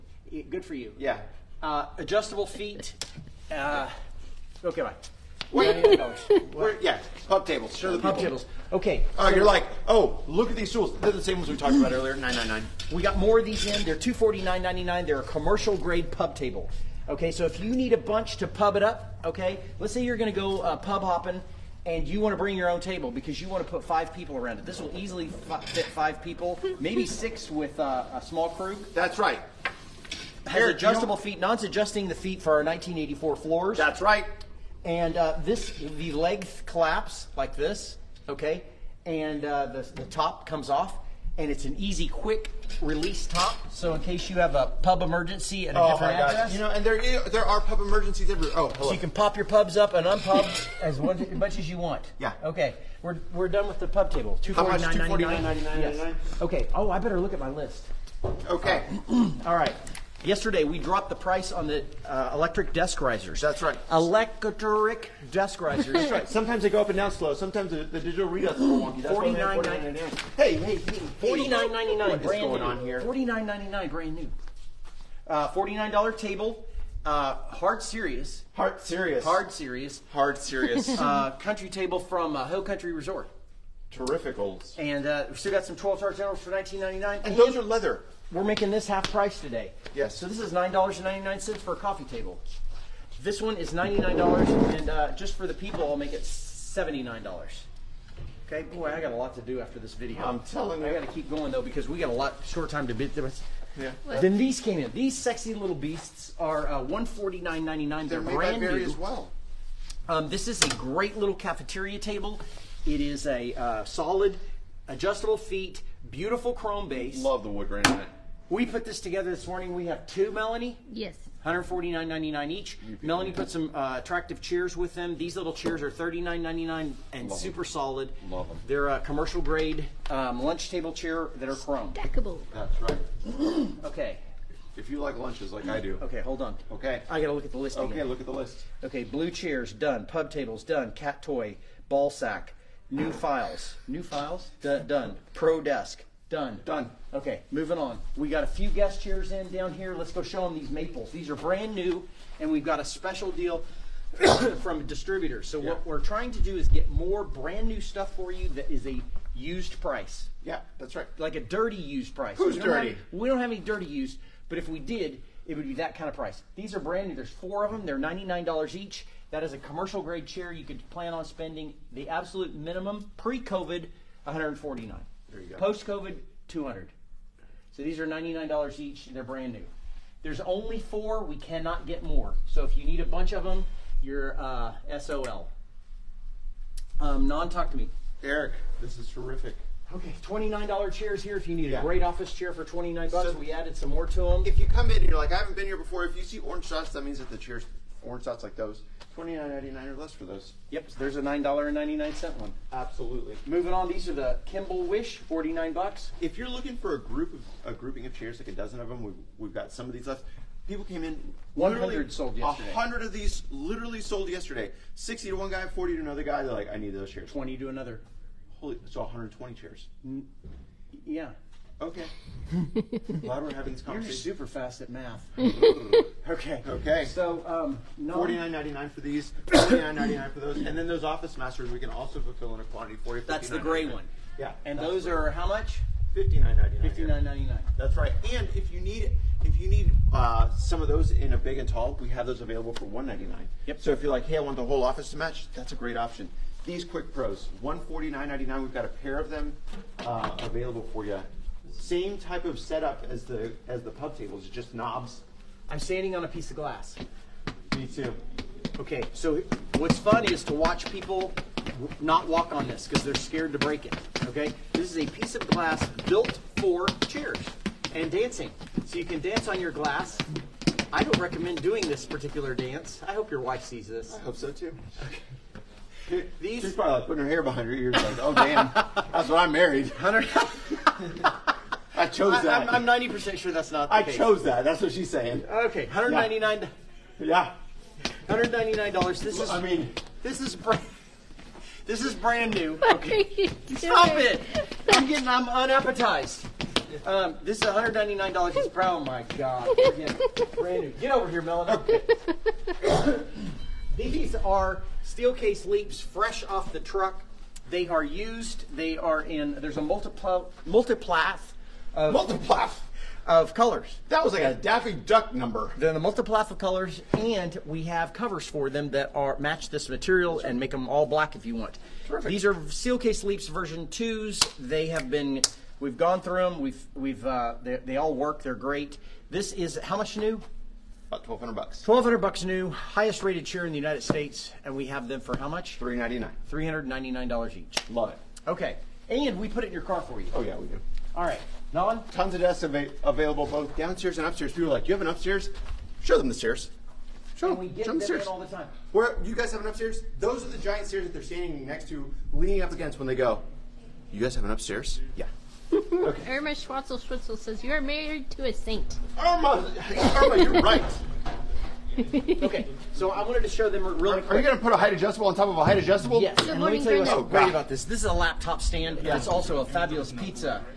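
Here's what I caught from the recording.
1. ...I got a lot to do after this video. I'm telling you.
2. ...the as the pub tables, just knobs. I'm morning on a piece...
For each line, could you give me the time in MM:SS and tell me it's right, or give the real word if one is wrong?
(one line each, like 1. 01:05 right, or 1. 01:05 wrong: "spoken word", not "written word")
1. 01:38 right
2. 04:13 wrong: "standing", not "morning".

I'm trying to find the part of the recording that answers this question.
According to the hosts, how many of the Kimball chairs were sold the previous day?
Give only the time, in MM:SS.
03:38.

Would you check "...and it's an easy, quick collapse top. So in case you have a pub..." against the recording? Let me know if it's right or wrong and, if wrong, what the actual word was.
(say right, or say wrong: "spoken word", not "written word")
wrong: "release", not "collapse".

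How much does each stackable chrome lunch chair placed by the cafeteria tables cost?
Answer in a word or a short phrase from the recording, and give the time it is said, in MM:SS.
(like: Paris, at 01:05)
$39.99, at 02:05.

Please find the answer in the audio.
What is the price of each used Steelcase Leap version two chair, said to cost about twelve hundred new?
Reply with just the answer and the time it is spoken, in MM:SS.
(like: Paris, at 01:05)
$399, at 05:35.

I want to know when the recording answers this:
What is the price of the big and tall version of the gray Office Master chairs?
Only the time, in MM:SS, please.
04:02.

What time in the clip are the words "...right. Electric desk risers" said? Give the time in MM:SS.
01:03.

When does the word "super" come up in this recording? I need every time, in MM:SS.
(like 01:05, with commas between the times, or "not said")
02:07, 03:44.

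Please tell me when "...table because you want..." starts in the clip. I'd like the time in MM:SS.
00:22.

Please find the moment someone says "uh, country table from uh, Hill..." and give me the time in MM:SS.
01:20.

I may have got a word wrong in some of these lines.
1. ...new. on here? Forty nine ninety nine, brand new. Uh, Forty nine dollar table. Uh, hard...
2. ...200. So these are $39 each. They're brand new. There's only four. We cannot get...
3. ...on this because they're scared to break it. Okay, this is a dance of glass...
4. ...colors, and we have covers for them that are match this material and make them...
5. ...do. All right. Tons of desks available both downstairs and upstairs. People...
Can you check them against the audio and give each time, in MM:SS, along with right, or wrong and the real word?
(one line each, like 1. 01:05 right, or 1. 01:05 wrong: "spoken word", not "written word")
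1. 01:12 right
2. 02:56 wrong: "99", not "39"
3. 04:22 wrong: "piece", not "dance"
4. 05:16 right
5. 05:40 right.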